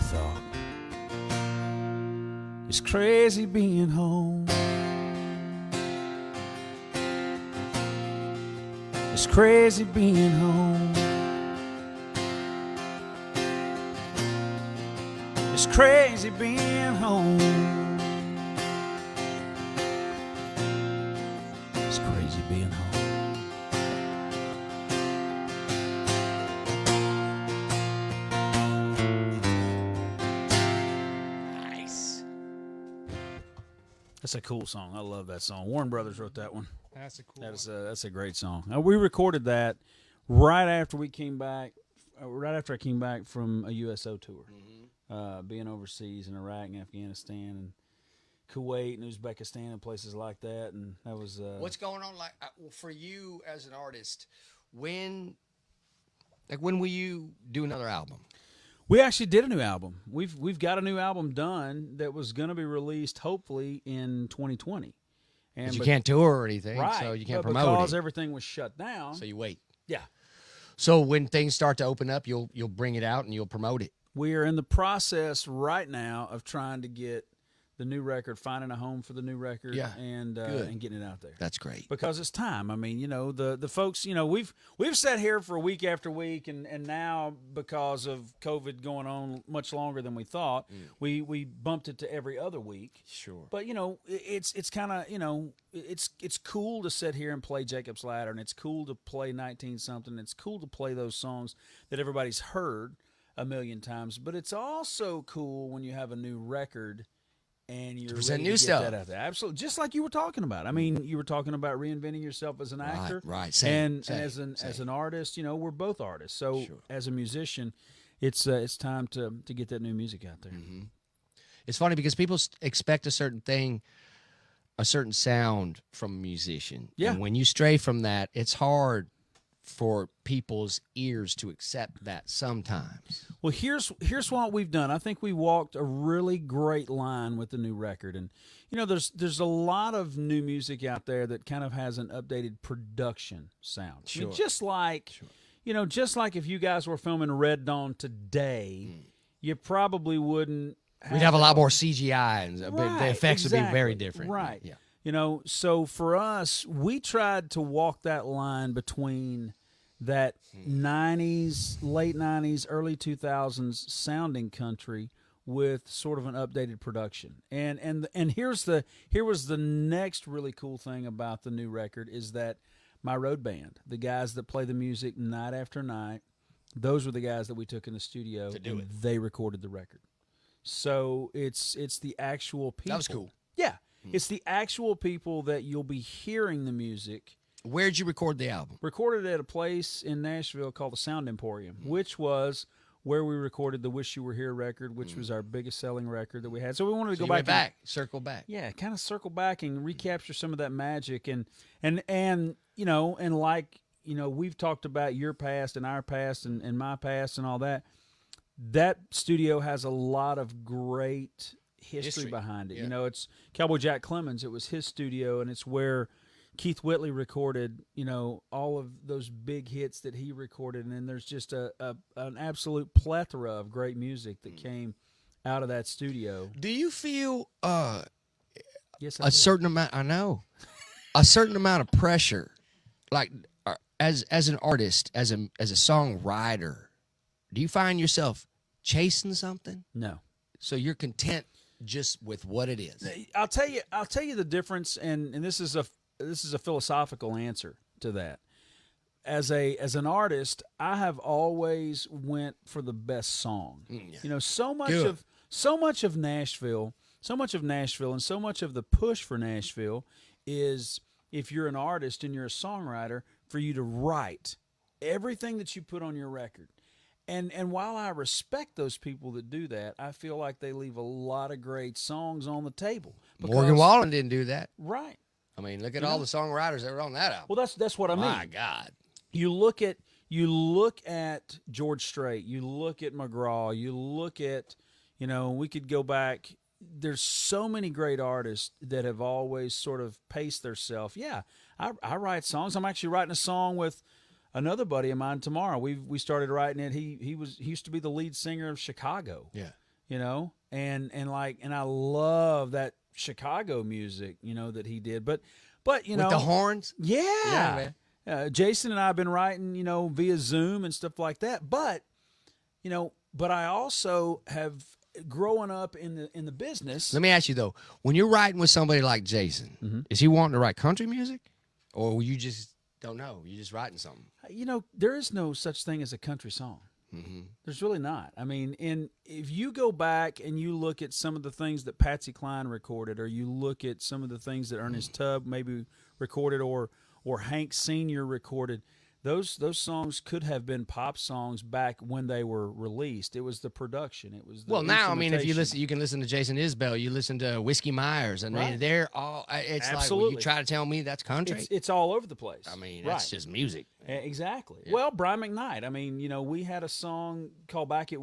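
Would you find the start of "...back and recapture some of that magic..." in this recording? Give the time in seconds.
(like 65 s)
199 s.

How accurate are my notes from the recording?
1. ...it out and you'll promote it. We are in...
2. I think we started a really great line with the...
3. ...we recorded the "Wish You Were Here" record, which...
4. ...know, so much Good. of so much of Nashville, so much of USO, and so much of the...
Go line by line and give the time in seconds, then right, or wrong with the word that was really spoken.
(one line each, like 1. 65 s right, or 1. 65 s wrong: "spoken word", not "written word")
1. 72 s right
2. 134 s wrong: "walked", not "started"
3. 193 s right
4. 254 s wrong: "Nashville", not "USO".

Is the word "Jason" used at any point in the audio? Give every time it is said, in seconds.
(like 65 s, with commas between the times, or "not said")
308 s, 319 s, 346 s.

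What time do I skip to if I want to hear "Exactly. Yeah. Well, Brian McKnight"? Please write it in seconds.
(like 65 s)
354 s.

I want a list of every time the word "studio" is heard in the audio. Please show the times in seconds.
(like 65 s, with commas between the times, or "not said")
178 s, 209 s, 214 s, 225 s.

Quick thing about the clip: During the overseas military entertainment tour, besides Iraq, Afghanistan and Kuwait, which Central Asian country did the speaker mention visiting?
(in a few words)
Uzbekistan.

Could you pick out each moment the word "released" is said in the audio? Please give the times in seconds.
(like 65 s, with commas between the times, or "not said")
62 s, 342 s.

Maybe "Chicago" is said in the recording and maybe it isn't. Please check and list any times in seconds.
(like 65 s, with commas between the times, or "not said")
298 s, 303 s.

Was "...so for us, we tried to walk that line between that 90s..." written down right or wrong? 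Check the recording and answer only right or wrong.
right.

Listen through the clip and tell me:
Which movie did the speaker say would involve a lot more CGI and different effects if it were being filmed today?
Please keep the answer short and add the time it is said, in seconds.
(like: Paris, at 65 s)
Red Dawn, at 147 s.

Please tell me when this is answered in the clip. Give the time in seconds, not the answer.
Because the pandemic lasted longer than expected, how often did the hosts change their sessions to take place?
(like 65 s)
92 s.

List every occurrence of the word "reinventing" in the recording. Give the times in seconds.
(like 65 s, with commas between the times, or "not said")
111 s.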